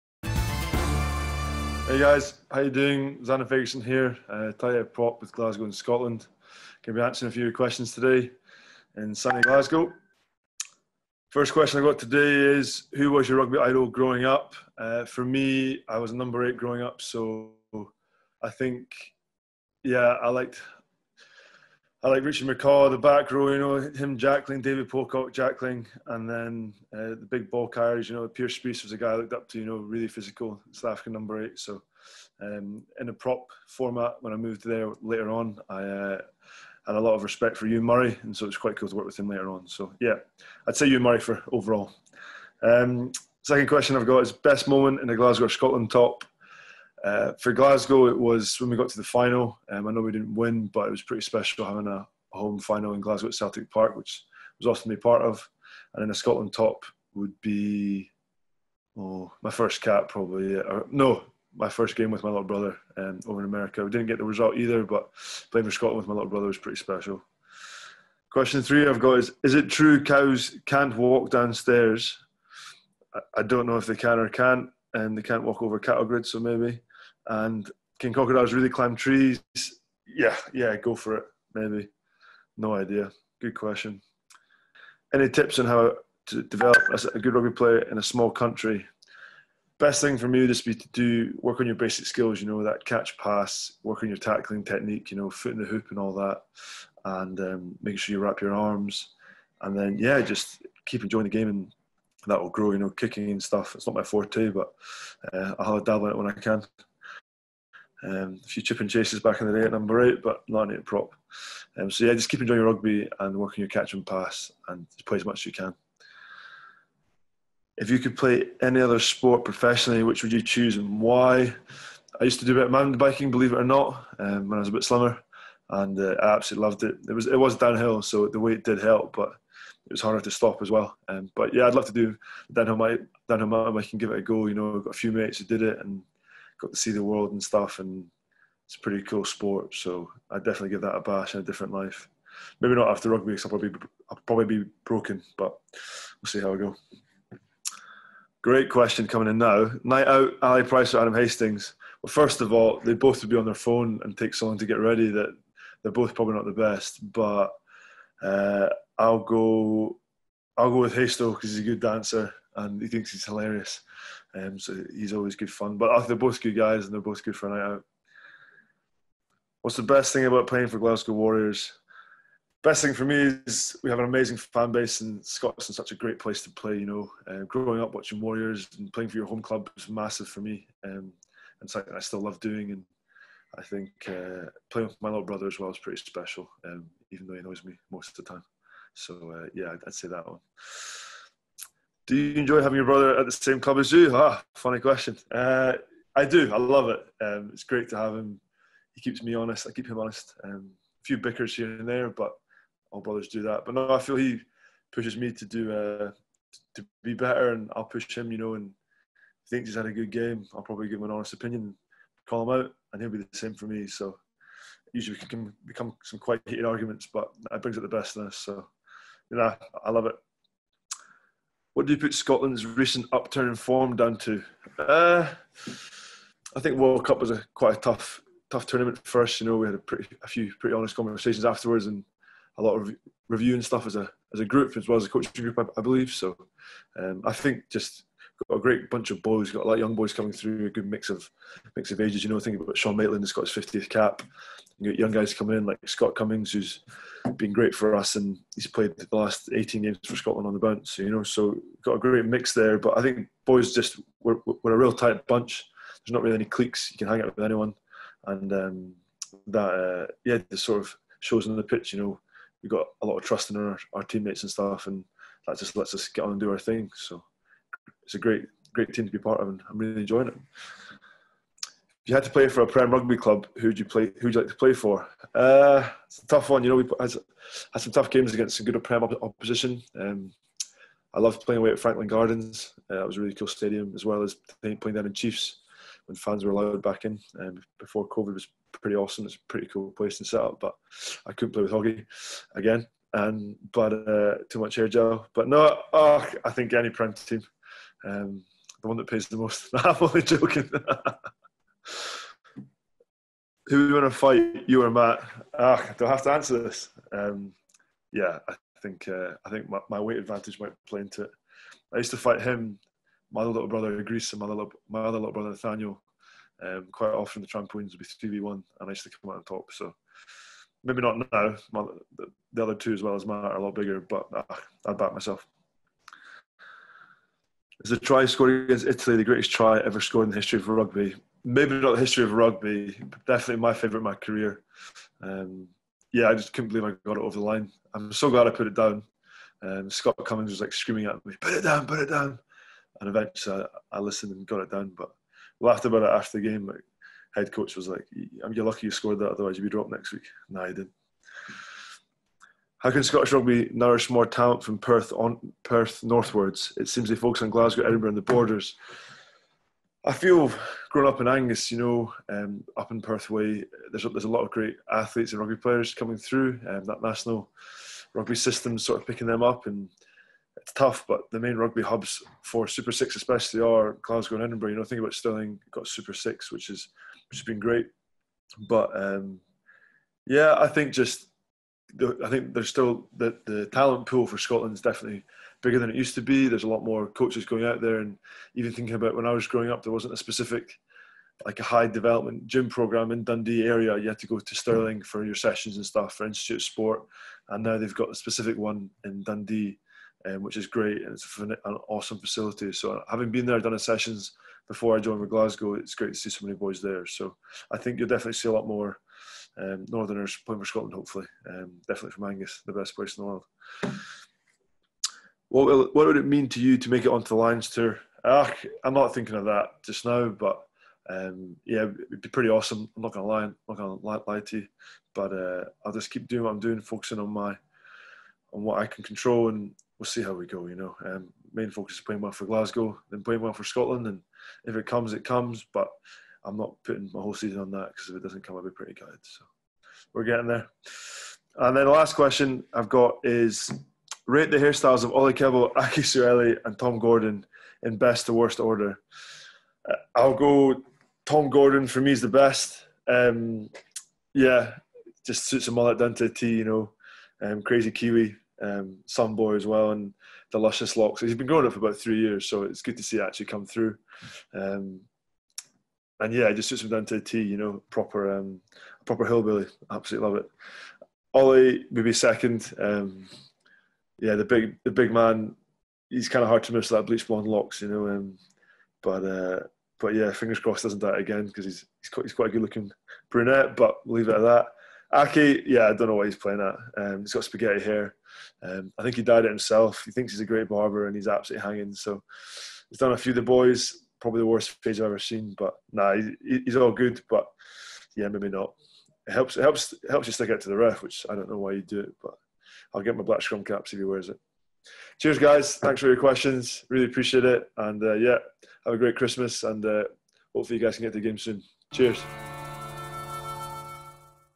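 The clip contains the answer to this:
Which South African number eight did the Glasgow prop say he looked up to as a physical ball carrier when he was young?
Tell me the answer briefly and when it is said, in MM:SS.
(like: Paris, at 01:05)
Pierre Spies, at 00:28.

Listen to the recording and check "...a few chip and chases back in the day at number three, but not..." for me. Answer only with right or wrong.
wrong.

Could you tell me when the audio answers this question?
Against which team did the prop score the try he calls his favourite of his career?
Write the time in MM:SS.
05:28.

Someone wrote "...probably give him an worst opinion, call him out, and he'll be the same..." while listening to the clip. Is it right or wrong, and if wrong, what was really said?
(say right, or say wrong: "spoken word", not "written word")
wrong: "honest", not "worst".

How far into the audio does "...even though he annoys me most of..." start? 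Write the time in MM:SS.
03:07.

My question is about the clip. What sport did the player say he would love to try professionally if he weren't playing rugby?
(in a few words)
Downhill mountain biking.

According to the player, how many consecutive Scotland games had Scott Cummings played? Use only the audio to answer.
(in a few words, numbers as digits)
18.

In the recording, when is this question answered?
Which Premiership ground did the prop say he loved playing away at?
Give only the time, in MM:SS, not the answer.
04:41.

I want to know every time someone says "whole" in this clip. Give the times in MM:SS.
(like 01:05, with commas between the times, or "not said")
07:17.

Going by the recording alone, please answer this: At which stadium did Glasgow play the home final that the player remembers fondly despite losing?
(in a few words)
Celtic Park.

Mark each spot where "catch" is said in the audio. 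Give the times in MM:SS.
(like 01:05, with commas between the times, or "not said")
01:32, 01:53.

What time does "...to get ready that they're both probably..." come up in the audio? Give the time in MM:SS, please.
02:34.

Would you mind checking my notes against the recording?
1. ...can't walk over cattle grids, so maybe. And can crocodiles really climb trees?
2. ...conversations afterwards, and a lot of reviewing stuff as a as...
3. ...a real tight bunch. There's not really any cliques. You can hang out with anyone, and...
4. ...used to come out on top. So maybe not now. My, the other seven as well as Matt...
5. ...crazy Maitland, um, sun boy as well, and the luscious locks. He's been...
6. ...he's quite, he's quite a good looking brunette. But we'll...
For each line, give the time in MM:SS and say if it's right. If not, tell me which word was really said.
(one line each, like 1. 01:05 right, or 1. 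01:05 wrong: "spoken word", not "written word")
1. 01:15 right
2. 03:50 right
3. 04:14 right
4. 05:18 wrong: "two", not "seven"
5. 07:37 wrong: "Kiwi", not "Maitland"
6. 08:02 right.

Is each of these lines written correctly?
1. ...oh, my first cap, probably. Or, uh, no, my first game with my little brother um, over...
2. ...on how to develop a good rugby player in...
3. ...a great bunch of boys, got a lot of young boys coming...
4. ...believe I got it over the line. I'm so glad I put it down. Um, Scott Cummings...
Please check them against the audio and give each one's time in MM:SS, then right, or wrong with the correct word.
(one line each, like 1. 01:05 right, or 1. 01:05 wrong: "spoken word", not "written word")
1. 00:58 right
2. 01:25 right
3. 03:58 right
4. 05:36 right.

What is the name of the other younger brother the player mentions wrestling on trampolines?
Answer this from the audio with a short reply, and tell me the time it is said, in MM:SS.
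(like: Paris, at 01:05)
Nathaniel, at 05:15.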